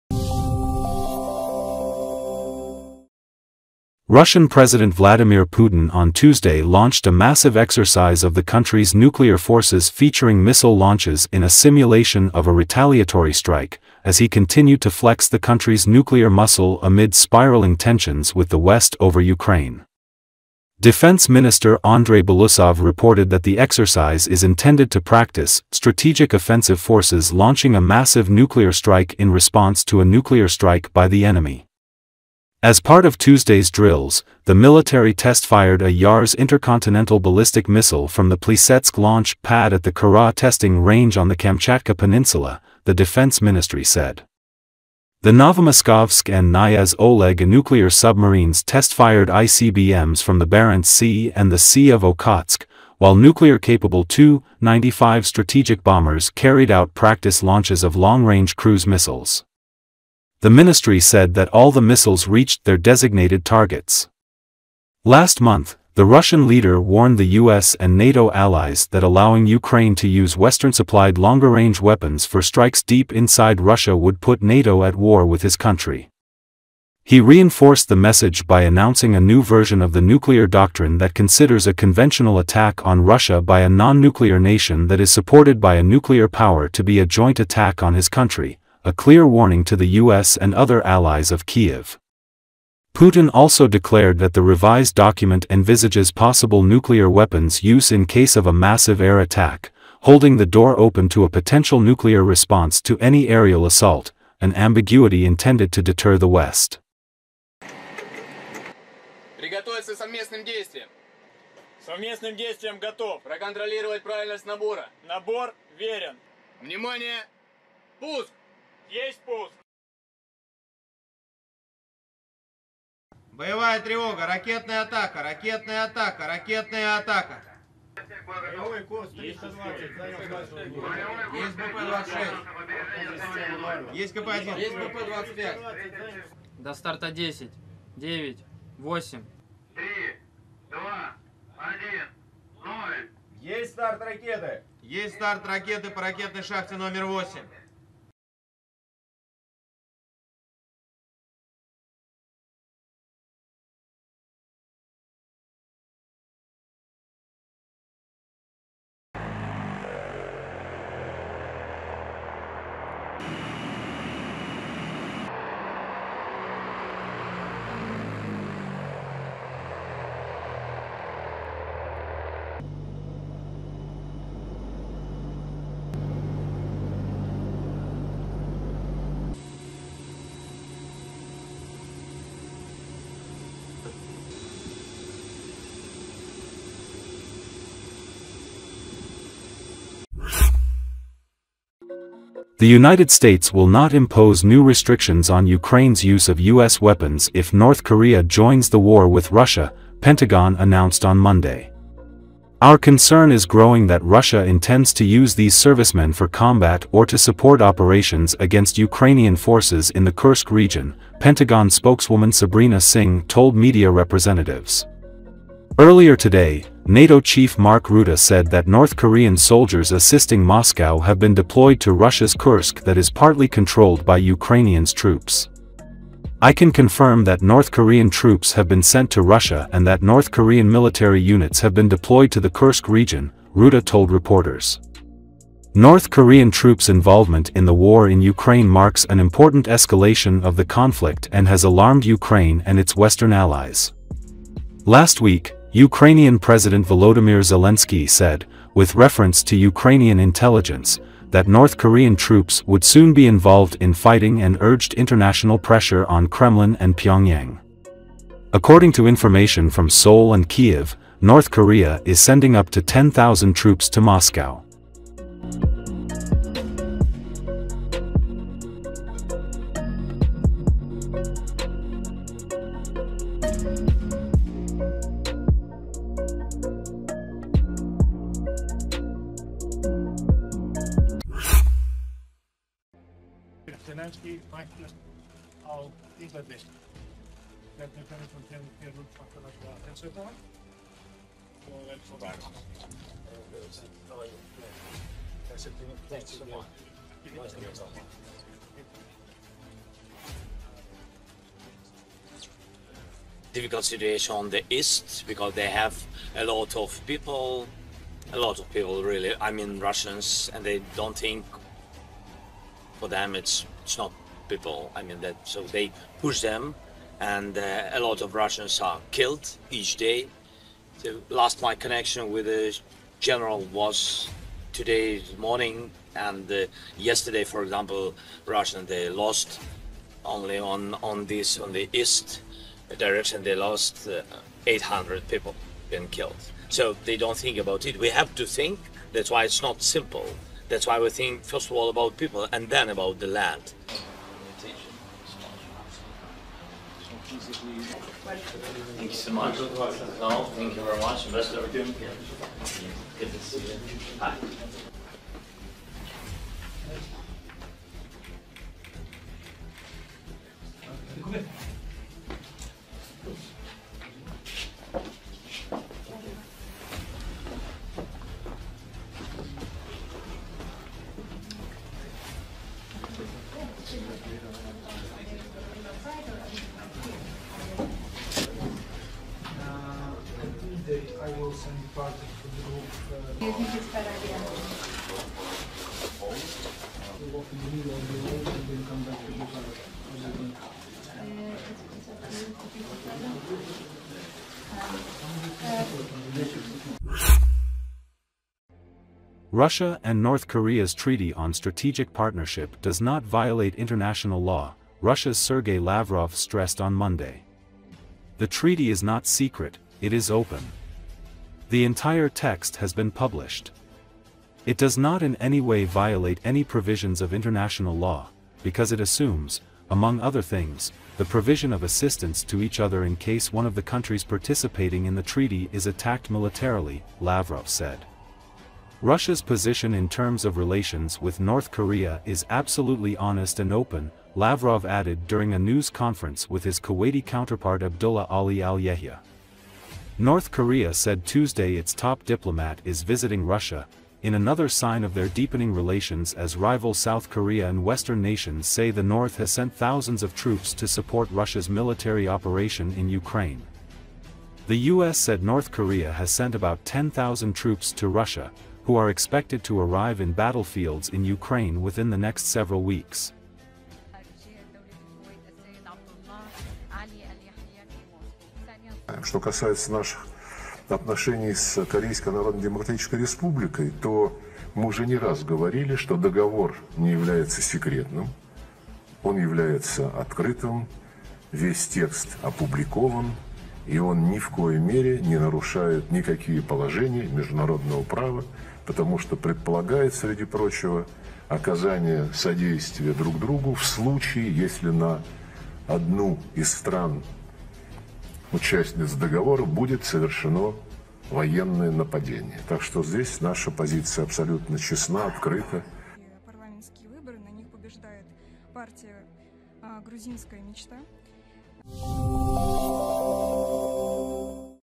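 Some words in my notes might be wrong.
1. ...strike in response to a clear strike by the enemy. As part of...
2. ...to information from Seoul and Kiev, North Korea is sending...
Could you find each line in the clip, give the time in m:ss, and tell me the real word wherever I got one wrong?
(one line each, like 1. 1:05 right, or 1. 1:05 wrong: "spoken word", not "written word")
1. 0:28 wrong: "nuclear", not "clear"
2. 4:18 right.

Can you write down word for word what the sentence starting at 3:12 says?
The United States will not impose new restrictions on Ukraine's use of U.S.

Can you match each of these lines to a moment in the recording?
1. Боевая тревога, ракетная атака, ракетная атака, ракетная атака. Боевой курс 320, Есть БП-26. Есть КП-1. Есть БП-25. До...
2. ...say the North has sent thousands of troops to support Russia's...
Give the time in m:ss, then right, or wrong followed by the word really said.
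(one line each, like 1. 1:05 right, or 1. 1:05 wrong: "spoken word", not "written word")
1. 2:03 right
2. 7:28 right.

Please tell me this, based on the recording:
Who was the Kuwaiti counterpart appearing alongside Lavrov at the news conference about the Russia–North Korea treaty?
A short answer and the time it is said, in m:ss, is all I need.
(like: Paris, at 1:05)
Abdullah Ali al-Yahya, at 7:17.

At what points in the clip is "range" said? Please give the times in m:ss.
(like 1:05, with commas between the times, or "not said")
0:40, 0:57, 1:11.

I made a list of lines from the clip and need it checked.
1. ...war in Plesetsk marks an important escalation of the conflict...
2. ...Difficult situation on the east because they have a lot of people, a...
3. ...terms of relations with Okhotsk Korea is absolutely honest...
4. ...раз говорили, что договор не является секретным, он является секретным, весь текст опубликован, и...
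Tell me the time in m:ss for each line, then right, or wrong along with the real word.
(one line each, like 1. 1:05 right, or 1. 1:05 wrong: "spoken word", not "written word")
1. 3:57 wrong: "Ukraine", not "Plesetsk"
2. 5:03 right
3. 7:10 wrong: "North", not "Okhotsk"
4. 7:55 wrong: "открытым", not "секретным".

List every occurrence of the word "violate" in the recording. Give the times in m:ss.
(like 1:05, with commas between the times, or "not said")
6:43, 6:55.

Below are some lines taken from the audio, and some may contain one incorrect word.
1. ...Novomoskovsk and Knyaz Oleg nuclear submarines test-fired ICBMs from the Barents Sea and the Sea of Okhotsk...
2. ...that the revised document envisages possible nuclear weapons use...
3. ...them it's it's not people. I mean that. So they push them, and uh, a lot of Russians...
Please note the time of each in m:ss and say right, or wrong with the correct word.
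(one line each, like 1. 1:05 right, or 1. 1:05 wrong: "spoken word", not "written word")
1. 0:45 right
2. 1:34 right
3. 5:13 right.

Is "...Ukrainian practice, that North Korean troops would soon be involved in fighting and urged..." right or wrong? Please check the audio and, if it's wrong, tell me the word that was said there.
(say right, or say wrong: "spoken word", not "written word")
wrong: "intelligence", not "practice".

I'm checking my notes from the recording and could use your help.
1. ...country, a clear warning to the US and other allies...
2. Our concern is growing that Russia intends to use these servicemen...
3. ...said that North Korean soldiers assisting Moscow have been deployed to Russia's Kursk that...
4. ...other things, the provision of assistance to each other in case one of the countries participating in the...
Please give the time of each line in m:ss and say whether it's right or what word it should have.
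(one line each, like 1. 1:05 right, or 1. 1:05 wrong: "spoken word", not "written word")
1. 1:28 right
2. 3:22 right
3. 3:38 right
4. 7:00 right.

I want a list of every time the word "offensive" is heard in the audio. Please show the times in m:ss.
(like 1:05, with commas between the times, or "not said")
0:26.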